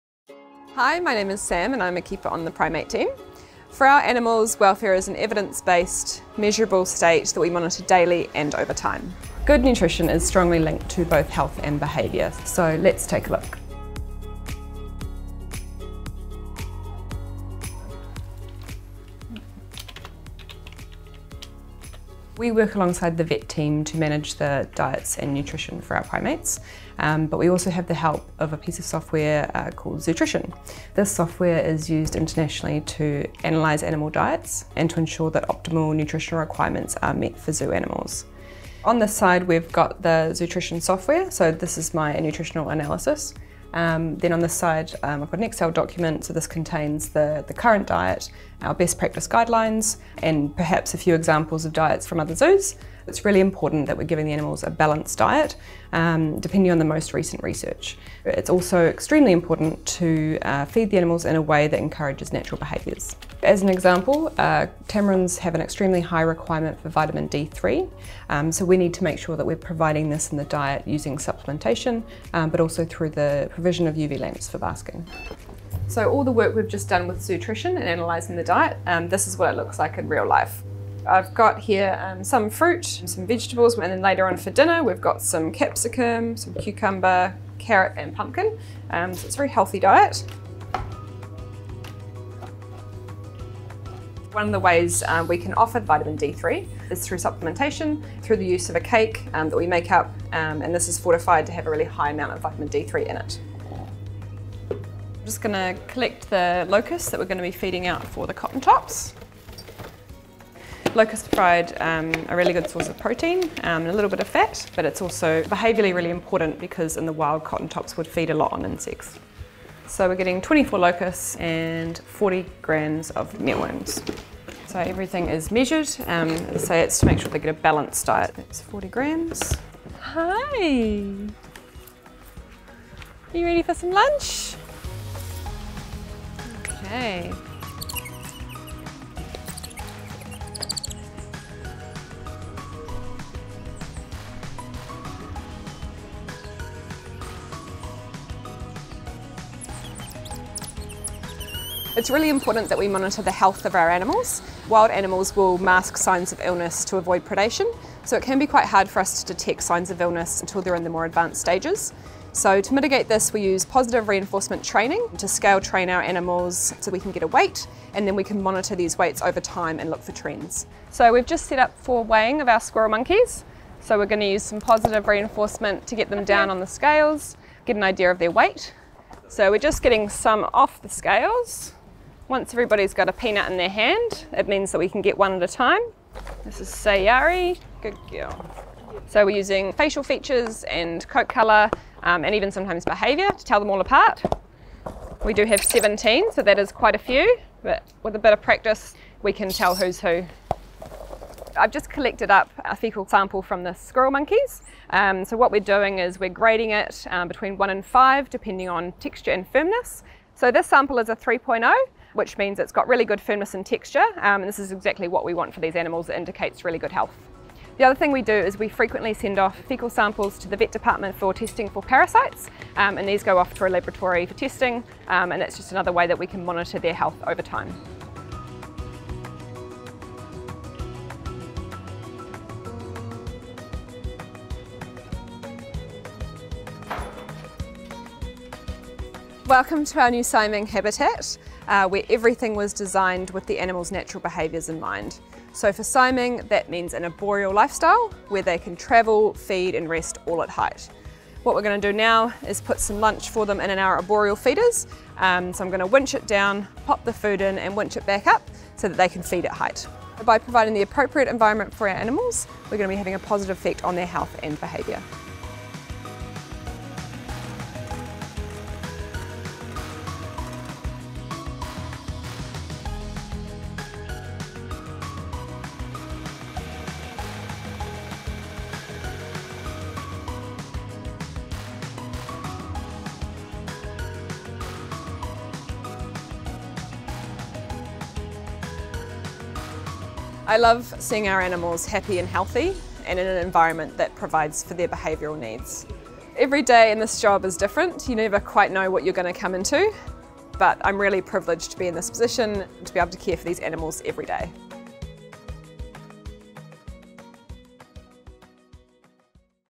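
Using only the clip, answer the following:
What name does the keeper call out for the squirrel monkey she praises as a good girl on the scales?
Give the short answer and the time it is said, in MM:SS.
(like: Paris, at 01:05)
Sayari, at 03:06.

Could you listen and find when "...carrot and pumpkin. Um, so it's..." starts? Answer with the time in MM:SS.
01:27.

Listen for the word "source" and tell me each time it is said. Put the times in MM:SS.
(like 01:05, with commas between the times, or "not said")
01:52.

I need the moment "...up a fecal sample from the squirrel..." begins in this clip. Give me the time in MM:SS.
03:22.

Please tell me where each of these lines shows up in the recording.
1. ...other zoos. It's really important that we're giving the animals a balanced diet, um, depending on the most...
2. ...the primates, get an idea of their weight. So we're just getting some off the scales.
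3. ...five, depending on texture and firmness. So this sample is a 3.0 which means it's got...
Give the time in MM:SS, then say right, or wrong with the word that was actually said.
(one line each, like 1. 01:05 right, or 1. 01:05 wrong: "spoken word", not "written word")
1. 00:52 right
2. 02:56 wrong: "scales", not "primates"
3. 03:27 right.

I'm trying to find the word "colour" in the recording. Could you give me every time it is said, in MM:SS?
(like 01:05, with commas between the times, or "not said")
03:11.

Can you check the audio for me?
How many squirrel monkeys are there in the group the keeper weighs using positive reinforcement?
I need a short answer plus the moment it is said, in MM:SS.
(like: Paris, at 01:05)
17, at 03:15.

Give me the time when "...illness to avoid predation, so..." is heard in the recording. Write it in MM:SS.
02:36.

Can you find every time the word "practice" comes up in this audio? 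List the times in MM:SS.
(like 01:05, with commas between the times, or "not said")
00:48, 03:18.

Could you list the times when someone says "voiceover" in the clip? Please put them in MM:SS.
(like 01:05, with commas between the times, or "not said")
not said.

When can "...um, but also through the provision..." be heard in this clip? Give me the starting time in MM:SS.
01:12.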